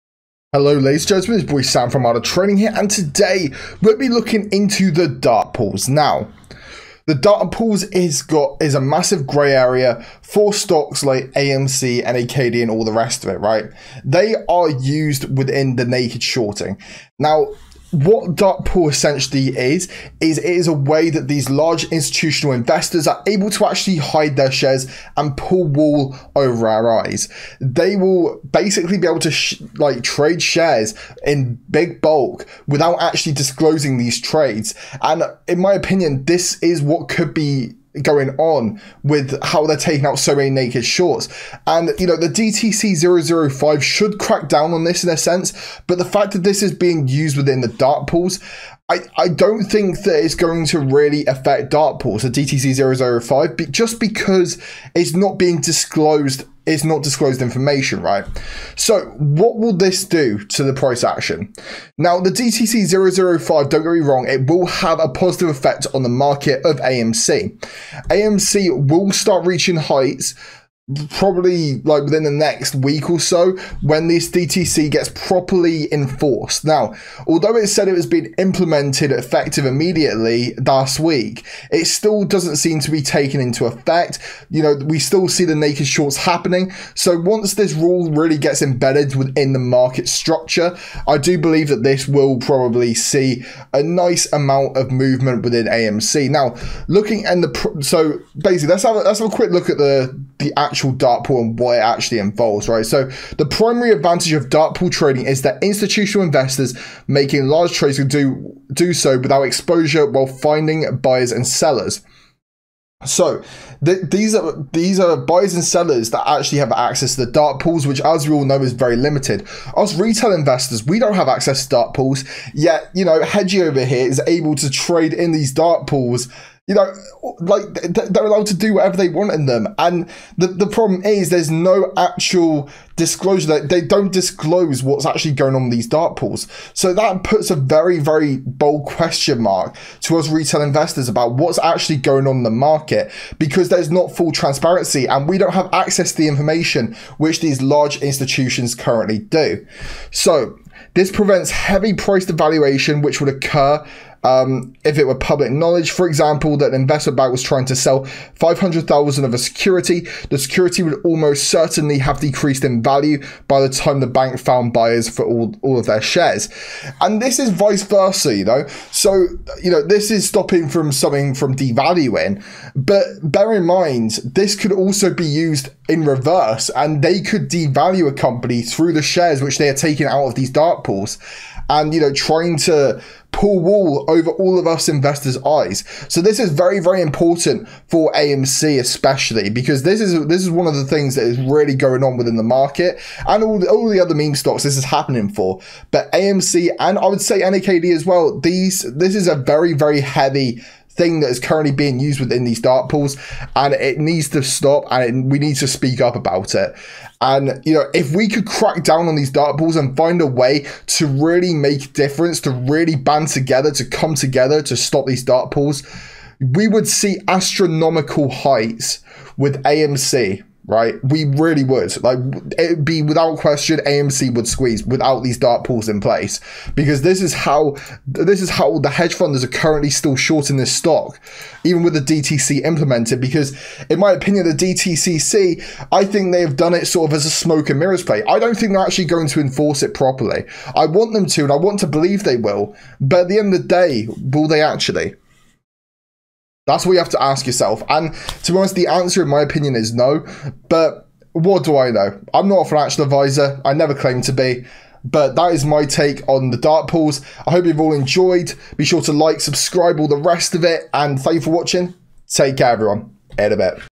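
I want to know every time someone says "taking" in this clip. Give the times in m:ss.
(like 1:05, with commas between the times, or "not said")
0:39, 2:59.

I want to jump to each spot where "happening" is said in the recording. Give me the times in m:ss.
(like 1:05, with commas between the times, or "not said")
1:26, 3:14.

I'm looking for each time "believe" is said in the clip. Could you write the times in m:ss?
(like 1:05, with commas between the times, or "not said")
1:31, 4:01.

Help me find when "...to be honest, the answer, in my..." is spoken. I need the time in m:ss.
4:08.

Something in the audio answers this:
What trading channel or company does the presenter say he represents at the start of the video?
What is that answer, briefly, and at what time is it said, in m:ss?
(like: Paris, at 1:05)
Armada Trading, at 0:02.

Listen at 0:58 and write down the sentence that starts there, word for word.
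So what will this do to the price action?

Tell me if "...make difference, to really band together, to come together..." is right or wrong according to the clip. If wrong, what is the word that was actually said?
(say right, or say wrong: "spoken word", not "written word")
right.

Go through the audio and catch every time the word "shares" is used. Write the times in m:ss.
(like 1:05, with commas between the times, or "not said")
0:24, 0:30, 2:46, 2:59.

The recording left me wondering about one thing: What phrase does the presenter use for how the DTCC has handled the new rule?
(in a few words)
smoke and mirrors.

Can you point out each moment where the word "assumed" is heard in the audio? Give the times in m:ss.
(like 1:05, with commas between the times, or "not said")
not said.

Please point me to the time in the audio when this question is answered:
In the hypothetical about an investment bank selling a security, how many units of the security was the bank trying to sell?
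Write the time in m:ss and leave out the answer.
2:38.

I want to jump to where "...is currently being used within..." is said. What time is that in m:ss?
3:21.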